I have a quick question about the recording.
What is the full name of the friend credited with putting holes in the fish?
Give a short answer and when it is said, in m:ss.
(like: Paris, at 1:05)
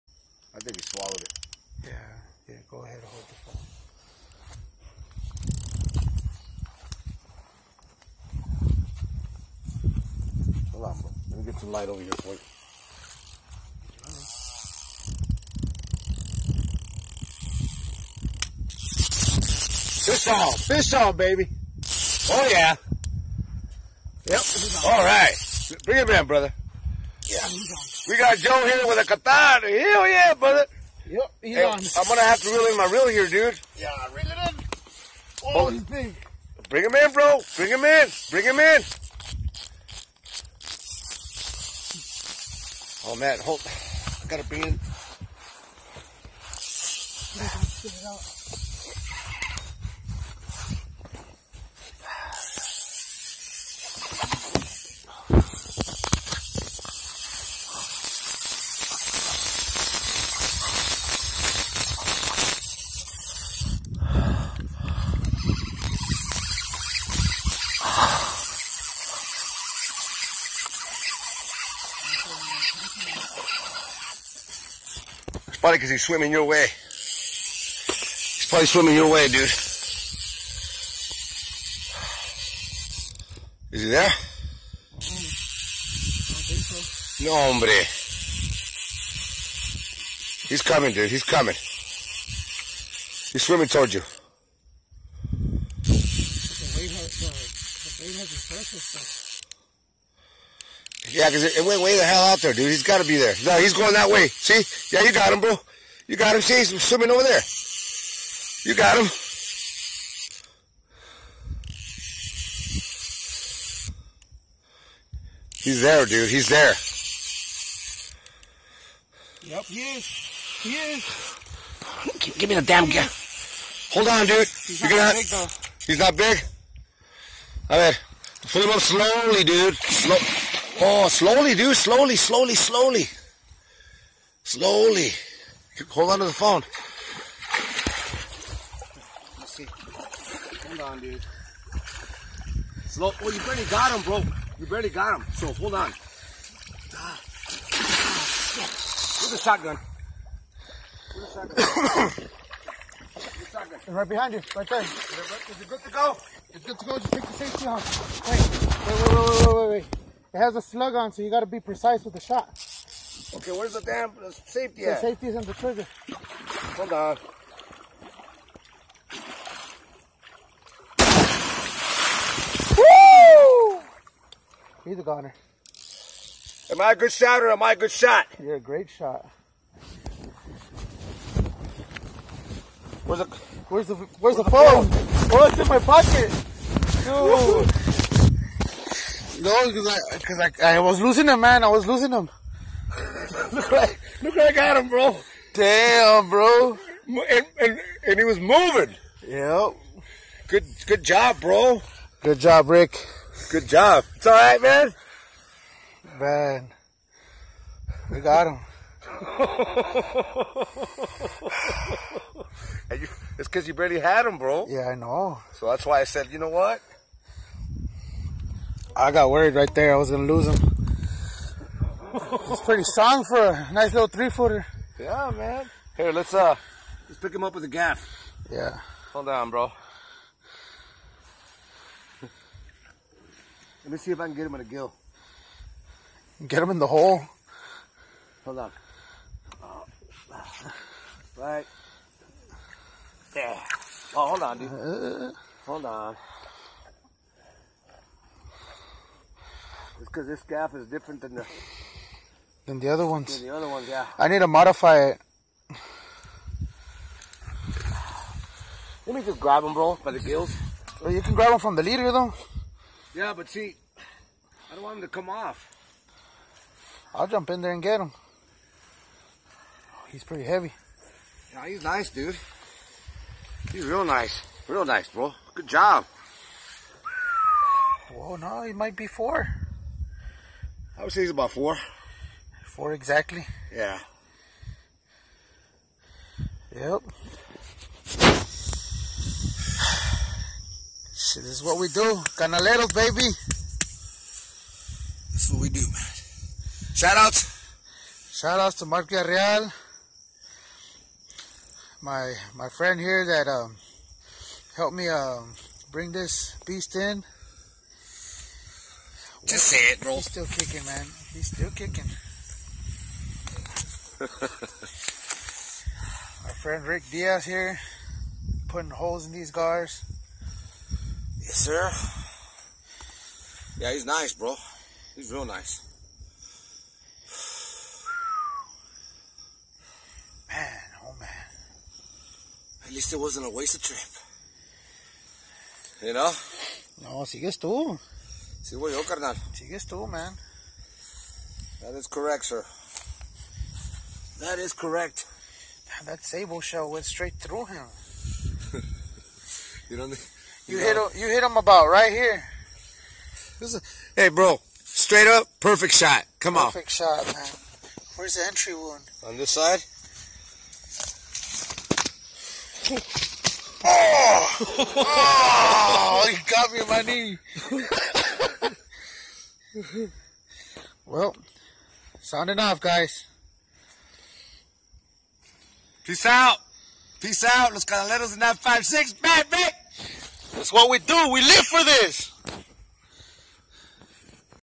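Rick Diaz, at 5:16.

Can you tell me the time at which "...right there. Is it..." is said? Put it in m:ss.
2:34.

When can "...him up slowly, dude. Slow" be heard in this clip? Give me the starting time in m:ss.
2:08.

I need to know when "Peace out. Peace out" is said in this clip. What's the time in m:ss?
6:16.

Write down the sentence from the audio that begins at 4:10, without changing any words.
because this gaff is different than the than the other ones.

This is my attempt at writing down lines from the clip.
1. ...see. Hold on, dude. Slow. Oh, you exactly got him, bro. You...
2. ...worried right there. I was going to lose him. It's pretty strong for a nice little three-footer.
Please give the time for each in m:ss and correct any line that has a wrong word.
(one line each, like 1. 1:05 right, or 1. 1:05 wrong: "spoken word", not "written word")
1. 2:19 wrong: "barely", not "exactly"
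2. 3:39 right.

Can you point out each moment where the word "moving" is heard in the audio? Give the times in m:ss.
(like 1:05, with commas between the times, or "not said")
3:18.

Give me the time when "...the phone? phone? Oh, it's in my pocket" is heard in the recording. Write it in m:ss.
3:04.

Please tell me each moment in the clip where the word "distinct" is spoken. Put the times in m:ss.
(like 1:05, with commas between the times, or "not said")
not said.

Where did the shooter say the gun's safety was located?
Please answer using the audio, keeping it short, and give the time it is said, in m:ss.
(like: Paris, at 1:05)
In the trigger, at 2:45.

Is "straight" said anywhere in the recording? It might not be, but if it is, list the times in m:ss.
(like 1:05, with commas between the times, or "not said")
5:47, 5:54.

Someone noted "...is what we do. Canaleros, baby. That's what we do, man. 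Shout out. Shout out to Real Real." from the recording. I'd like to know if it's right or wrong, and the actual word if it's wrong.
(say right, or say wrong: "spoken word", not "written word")
wrong: "Mark", not "Real".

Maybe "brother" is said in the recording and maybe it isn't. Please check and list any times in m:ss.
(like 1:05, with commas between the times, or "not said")
0:26, 0:30.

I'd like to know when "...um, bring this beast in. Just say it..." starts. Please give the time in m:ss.
5:05.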